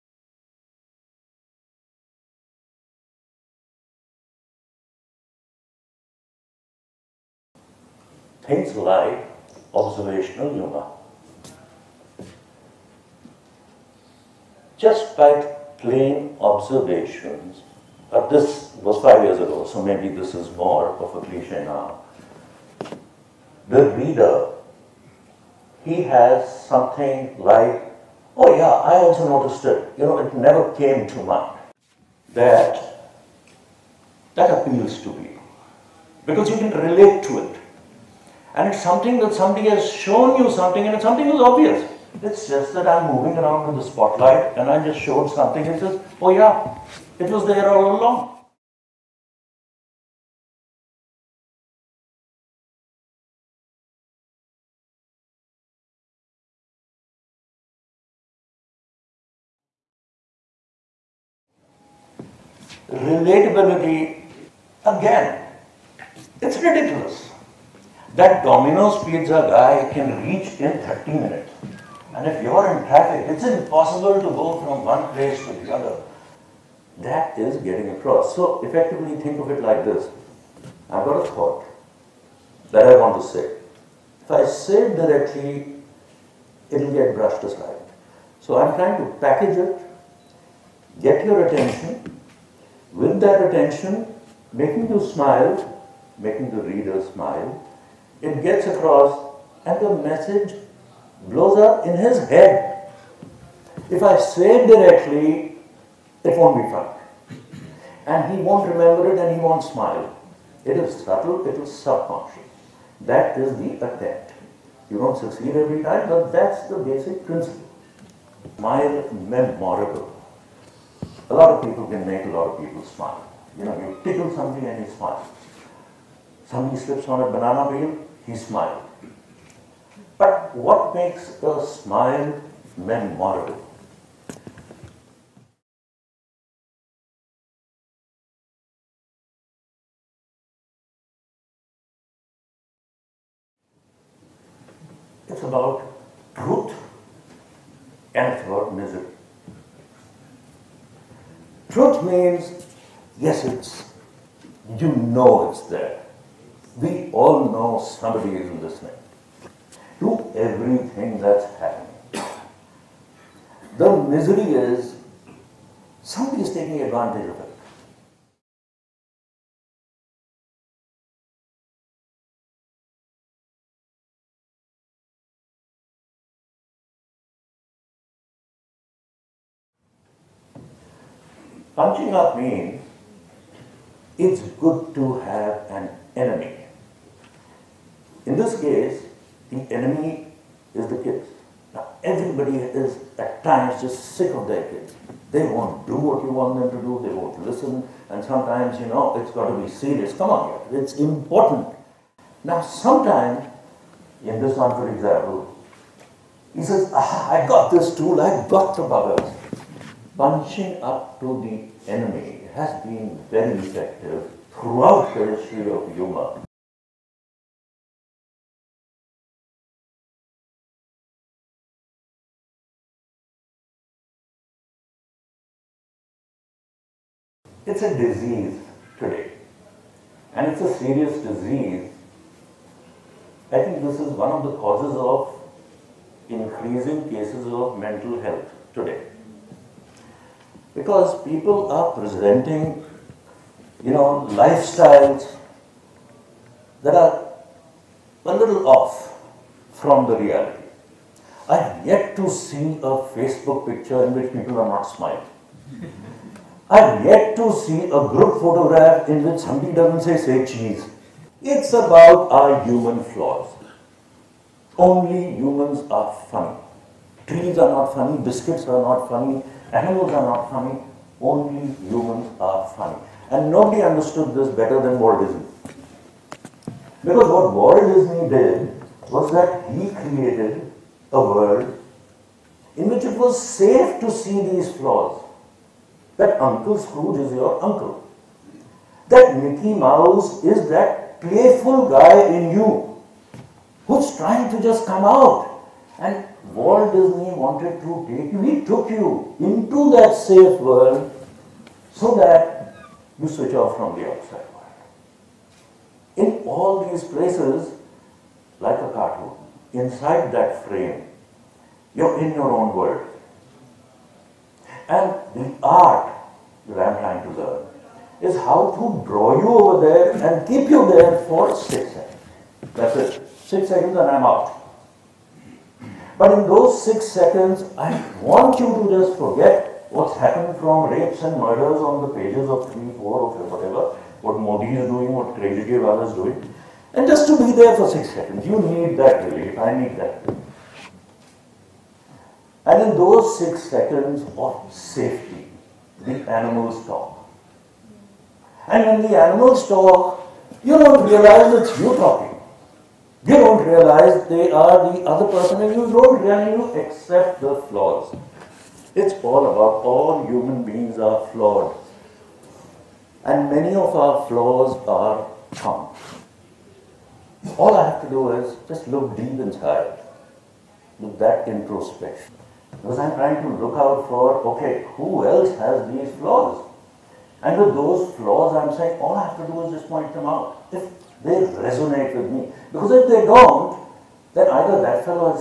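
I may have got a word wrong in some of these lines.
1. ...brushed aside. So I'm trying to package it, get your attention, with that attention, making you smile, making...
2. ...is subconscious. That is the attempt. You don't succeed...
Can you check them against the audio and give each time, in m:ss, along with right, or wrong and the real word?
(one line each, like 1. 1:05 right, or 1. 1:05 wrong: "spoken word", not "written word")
1. 1:27 right
2. 1:51 right.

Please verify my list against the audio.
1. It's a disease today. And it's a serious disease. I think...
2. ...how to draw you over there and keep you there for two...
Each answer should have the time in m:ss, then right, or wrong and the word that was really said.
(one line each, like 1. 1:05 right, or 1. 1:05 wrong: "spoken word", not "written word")
1. 3:47 right
2. 5:18 wrong: "six", not "two".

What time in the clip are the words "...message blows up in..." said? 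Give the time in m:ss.
1:40.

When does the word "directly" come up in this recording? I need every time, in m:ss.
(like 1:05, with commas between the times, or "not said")
1:24, 1:44.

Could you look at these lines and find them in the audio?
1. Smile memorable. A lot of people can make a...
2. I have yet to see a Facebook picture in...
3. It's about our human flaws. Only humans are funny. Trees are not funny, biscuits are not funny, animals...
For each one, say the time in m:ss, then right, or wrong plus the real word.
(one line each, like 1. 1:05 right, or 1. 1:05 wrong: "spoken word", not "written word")
1. 1:58 right
2. 4:11 right
3. 4:21 right.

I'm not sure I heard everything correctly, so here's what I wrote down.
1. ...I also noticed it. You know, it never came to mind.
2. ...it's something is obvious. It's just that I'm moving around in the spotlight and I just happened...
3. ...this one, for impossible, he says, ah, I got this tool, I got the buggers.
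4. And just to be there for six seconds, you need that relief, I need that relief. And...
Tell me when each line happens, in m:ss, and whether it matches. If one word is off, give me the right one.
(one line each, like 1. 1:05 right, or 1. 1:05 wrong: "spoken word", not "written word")
1. 0:28 right
2. 0:40 wrong: "showed", not "happened"
3. 3:24 wrong: "example", not "impossible"
4. 5:36 right.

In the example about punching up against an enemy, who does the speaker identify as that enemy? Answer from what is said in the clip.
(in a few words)
the kids.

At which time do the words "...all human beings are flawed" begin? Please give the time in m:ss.
5:59.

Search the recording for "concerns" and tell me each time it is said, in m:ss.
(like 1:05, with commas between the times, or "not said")
not said.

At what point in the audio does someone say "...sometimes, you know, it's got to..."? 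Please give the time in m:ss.
3:18.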